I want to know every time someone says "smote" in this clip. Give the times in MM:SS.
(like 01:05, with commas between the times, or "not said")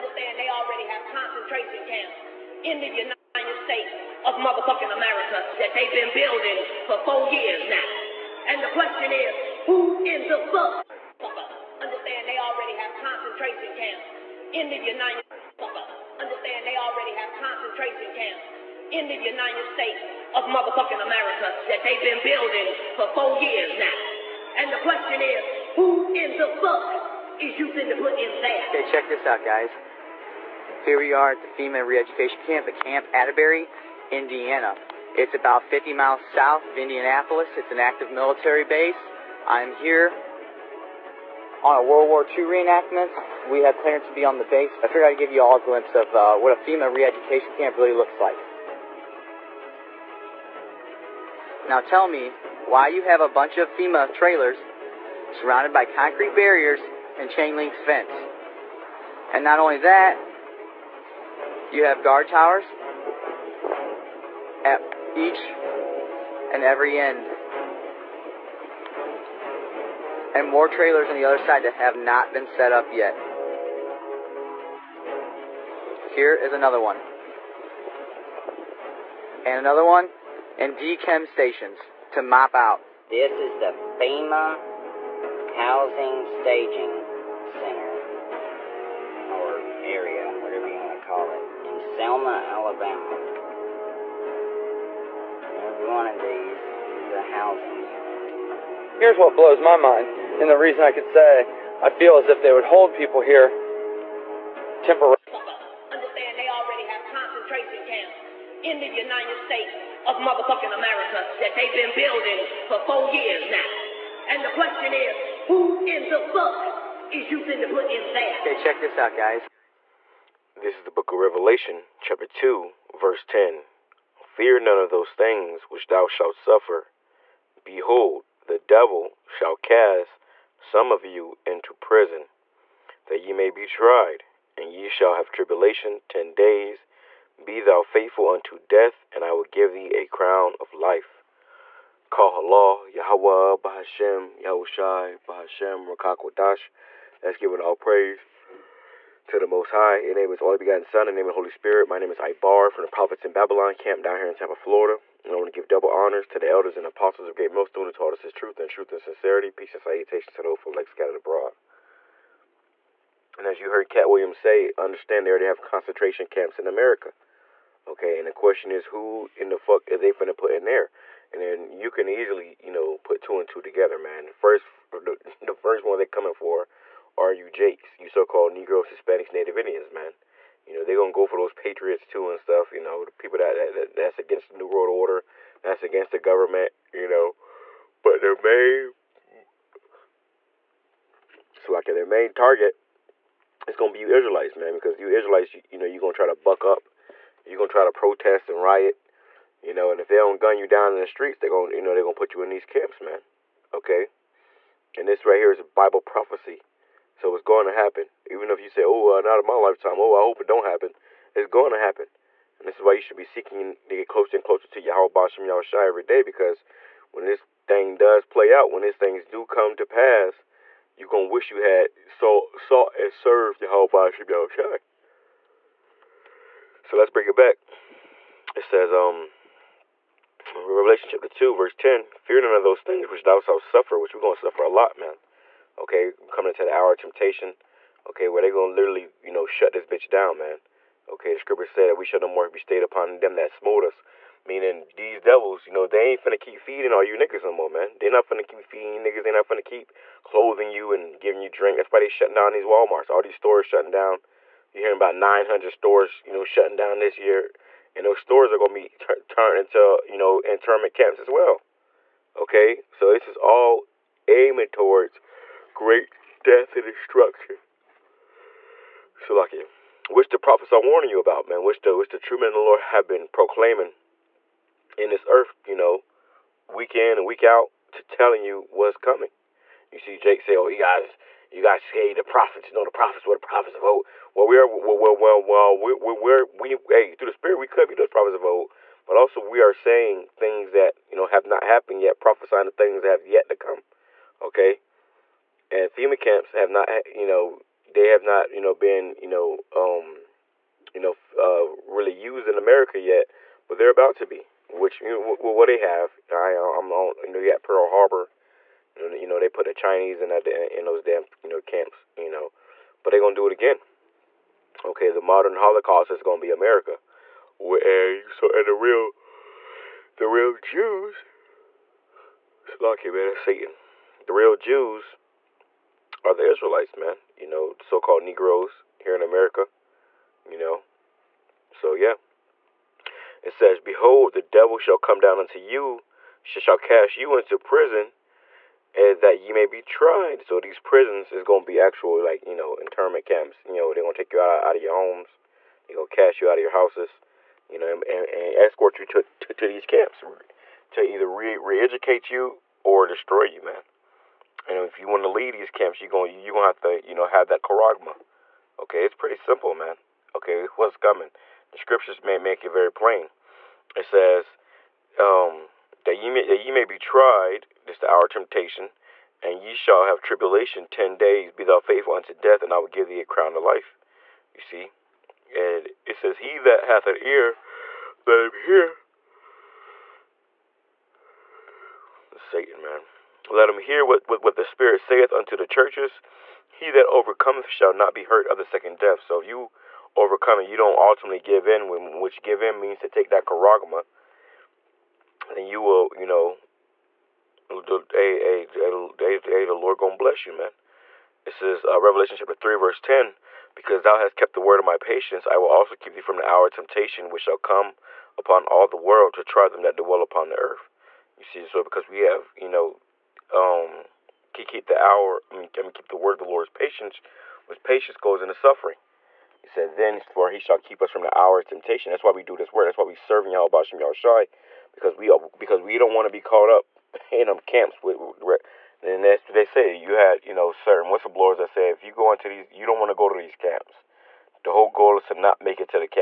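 04:03.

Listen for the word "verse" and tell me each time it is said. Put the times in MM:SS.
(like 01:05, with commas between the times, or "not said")
02:02, 03:51, 06:42.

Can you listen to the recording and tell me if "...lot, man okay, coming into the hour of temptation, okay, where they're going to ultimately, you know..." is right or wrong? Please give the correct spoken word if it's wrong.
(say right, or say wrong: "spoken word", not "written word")
wrong: "literally", not "ultimately".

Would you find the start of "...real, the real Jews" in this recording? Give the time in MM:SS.
05:18.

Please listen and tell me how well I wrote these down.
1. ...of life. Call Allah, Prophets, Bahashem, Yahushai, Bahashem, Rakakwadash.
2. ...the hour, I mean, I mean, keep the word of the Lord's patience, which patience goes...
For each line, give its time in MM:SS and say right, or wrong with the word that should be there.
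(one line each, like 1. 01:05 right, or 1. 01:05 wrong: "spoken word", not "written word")
1. 02:20 wrong: "Yahweh", not "Prophets"
2. 06:54 right.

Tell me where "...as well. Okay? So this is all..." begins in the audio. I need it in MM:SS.
04:21.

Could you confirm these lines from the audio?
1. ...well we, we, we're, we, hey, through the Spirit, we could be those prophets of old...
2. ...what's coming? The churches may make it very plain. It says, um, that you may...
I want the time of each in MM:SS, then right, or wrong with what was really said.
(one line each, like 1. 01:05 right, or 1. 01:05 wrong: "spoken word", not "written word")
1. 04:45 right
2. 06:00 wrong: "scriptures", not "churches".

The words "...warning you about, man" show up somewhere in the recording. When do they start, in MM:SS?
04:30.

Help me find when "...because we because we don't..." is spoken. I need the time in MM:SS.
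07:04.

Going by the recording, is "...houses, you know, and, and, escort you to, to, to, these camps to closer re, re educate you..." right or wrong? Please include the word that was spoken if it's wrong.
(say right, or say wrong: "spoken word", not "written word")
wrong: "either", not "closer".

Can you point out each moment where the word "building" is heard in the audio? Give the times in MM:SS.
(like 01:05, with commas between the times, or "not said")
00:06, 00:22, 01:51.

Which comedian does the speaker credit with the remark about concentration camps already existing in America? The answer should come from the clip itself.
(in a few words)
Katt Williams.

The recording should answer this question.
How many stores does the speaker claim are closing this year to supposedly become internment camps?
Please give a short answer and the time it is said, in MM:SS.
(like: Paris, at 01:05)
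900, at 04:15.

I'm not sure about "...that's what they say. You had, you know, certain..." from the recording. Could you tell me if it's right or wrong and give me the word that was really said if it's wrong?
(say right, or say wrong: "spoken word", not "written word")
right.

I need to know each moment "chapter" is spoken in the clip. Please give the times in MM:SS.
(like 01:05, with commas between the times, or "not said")
02:02, 03:51, 06:42.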